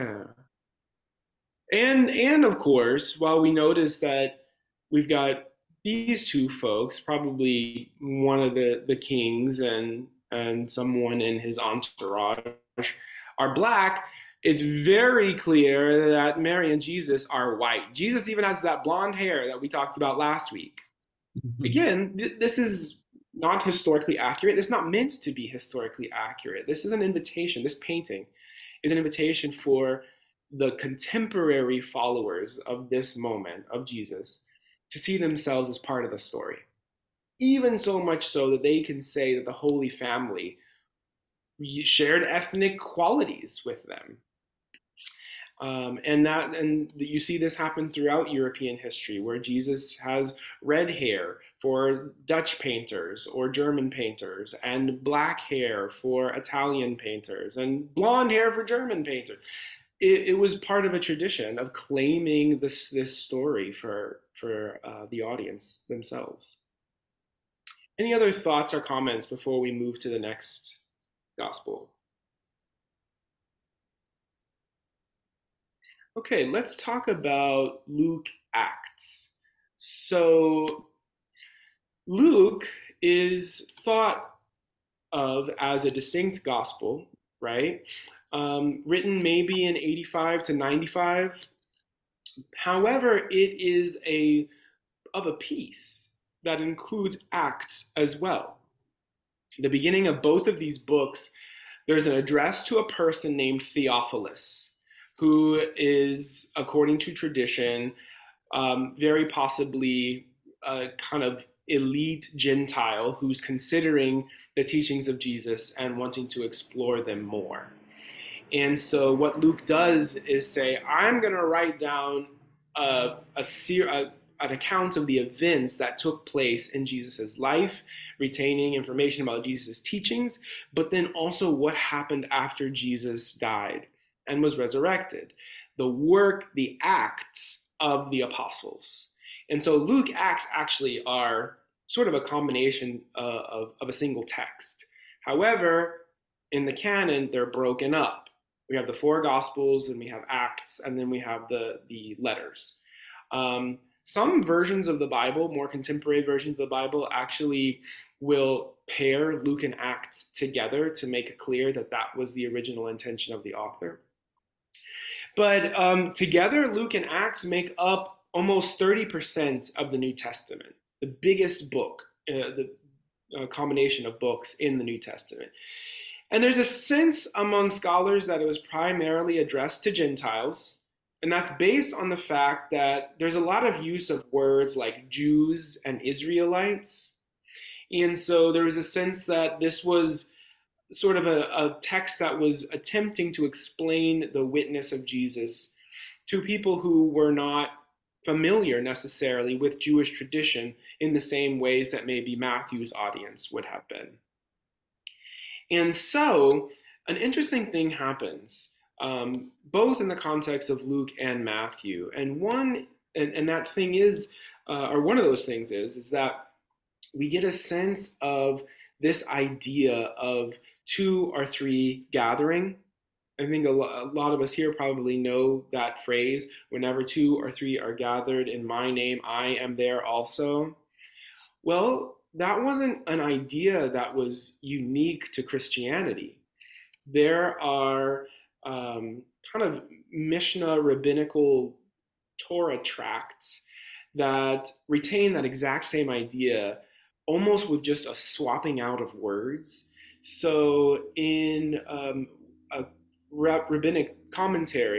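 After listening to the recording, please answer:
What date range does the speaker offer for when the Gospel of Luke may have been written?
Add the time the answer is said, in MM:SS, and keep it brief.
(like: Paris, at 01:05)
85 to 95, at 01:29.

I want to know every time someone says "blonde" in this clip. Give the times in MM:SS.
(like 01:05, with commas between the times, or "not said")
00:18, 00:57.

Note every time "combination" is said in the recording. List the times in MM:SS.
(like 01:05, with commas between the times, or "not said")
02:22, 02:53.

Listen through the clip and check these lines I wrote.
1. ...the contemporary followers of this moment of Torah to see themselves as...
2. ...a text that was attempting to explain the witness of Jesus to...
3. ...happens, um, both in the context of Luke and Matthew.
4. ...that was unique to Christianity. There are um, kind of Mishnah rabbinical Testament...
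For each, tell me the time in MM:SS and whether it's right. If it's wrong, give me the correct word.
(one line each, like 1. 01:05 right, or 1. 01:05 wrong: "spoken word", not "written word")
1. 00:30 wrong: "Jesus", not "Torah"
2. 03:11 right
3. 03:27 right
4. 03:53 wrong: "Torah", not "Testament".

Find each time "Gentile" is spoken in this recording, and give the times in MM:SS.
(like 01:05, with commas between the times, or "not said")
01:52, 02:59.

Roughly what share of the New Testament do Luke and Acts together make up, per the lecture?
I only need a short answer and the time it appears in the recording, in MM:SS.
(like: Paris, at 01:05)
almost 30%, at 02:48.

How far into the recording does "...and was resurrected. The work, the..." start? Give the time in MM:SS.
02:14.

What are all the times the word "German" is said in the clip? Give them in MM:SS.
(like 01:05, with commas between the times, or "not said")
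00:53, 00:58.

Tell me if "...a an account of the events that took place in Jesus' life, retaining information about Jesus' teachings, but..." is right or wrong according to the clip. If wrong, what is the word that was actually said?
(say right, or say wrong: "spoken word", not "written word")
right.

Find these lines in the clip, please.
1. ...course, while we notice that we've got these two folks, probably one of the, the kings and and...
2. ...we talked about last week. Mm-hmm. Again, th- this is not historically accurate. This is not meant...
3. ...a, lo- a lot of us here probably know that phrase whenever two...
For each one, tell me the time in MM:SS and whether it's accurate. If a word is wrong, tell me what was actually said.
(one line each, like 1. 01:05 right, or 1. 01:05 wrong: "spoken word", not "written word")
1. 00:02 right
2. 00:19 right
3. 03:43 right.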